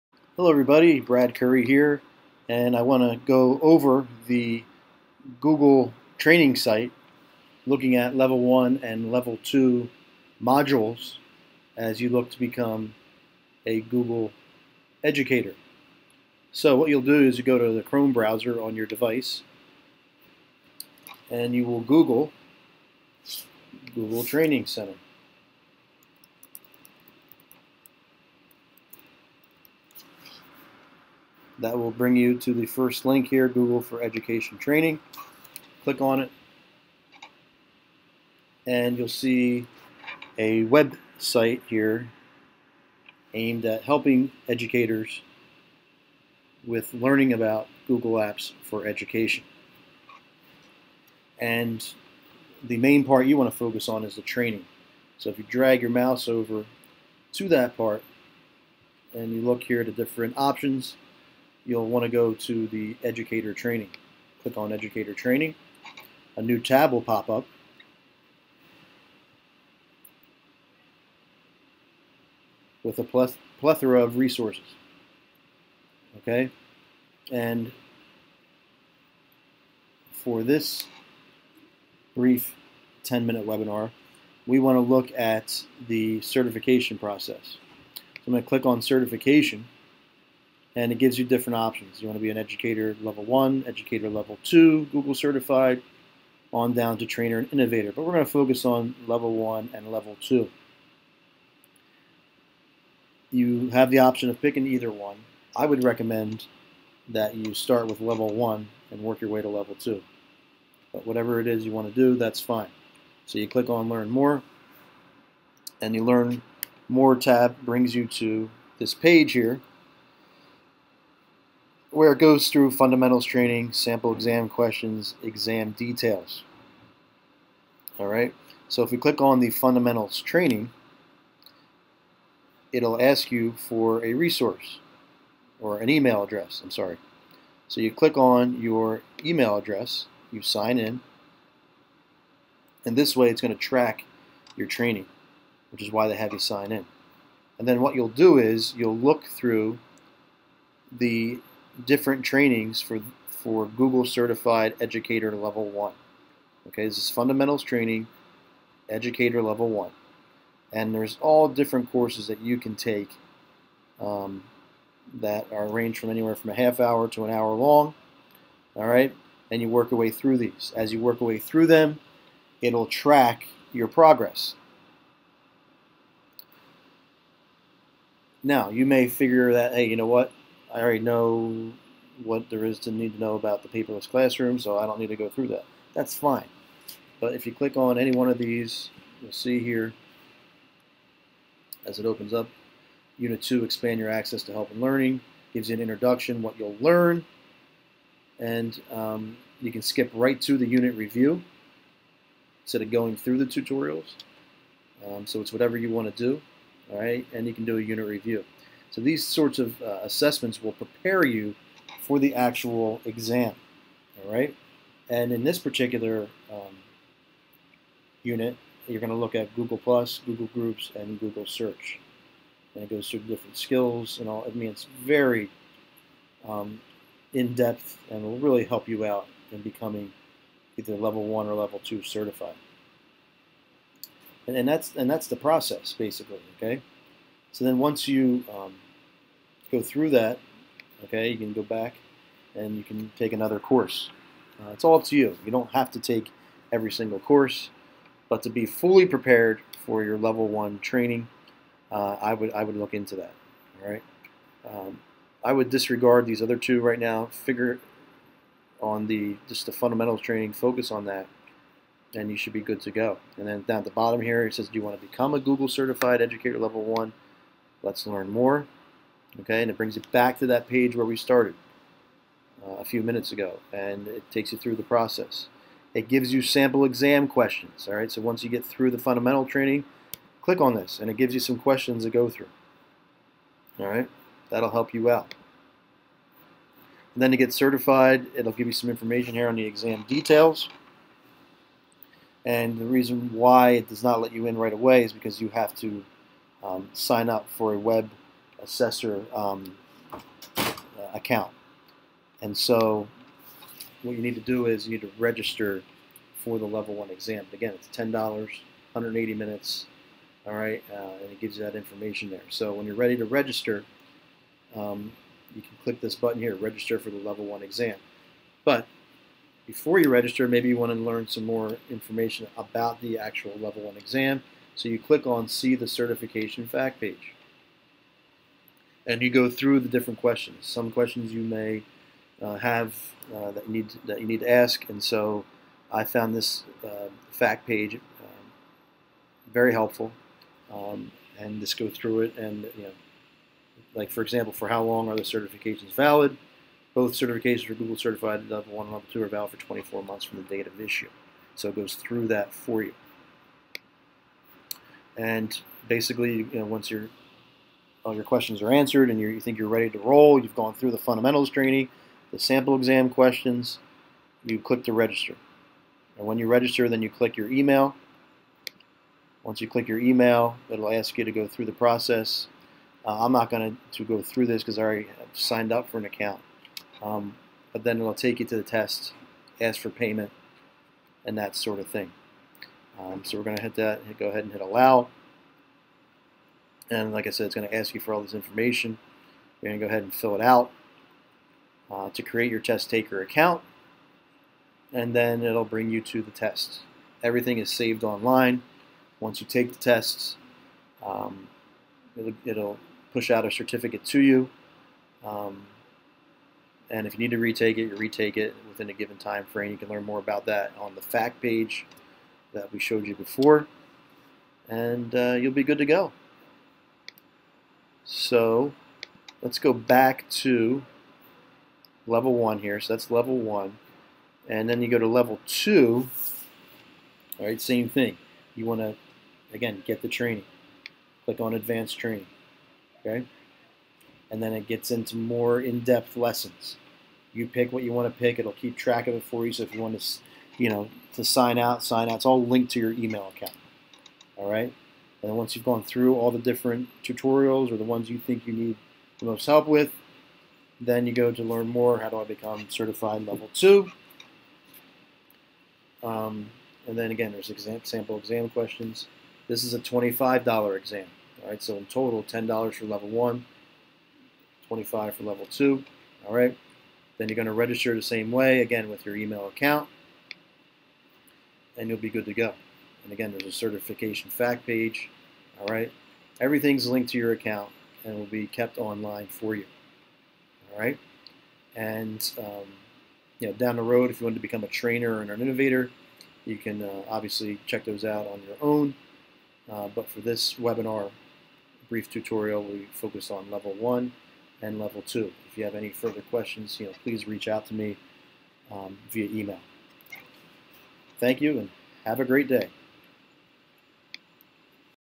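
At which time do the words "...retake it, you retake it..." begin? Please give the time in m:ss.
6:47.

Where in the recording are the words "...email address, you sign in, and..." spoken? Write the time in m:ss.
2:19.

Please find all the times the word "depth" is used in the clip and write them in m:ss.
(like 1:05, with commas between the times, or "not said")
3:47, 7:15.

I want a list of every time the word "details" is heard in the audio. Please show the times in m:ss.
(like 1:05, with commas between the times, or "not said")
2:05, 4:50.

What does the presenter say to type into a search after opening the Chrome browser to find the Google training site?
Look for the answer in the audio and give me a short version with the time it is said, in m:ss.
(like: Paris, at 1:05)
Google Training Center, at 0:23.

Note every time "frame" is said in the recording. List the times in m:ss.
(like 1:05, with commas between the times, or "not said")
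6:49.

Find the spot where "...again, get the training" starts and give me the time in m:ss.
7:09.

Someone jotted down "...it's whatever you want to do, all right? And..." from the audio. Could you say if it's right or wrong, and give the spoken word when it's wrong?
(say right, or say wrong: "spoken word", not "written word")
right.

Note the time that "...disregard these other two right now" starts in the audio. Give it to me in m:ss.
4:15.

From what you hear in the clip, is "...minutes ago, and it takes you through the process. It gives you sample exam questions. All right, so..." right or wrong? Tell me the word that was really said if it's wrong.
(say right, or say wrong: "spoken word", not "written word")
right.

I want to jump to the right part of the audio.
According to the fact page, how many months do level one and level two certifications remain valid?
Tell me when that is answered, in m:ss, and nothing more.
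5:49.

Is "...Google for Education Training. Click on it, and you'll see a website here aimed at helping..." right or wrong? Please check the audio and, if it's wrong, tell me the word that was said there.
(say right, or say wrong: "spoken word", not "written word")
right.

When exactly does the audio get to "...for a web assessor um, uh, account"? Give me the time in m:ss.
4:57.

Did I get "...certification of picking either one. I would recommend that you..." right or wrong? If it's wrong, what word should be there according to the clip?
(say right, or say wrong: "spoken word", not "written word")
wrong: "option", not "certification".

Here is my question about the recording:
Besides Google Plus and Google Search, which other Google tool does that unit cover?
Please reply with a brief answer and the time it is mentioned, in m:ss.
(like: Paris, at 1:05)
Google Groups, at 3:40.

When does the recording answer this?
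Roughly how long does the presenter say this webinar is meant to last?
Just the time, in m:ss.
1:23.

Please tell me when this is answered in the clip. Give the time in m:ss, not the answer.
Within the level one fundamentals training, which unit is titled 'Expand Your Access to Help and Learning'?
3:13.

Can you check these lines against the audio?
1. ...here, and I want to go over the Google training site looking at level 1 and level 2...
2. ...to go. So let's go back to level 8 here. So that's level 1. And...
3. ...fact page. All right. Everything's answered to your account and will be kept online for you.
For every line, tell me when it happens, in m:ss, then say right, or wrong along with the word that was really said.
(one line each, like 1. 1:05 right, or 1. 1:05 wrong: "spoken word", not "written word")
1. 0:01 right
2. 6:55 wrong: "1", not "8"
3. 7:54 wrong: "linked", not "answered".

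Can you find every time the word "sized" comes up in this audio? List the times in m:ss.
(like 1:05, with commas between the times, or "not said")
not said.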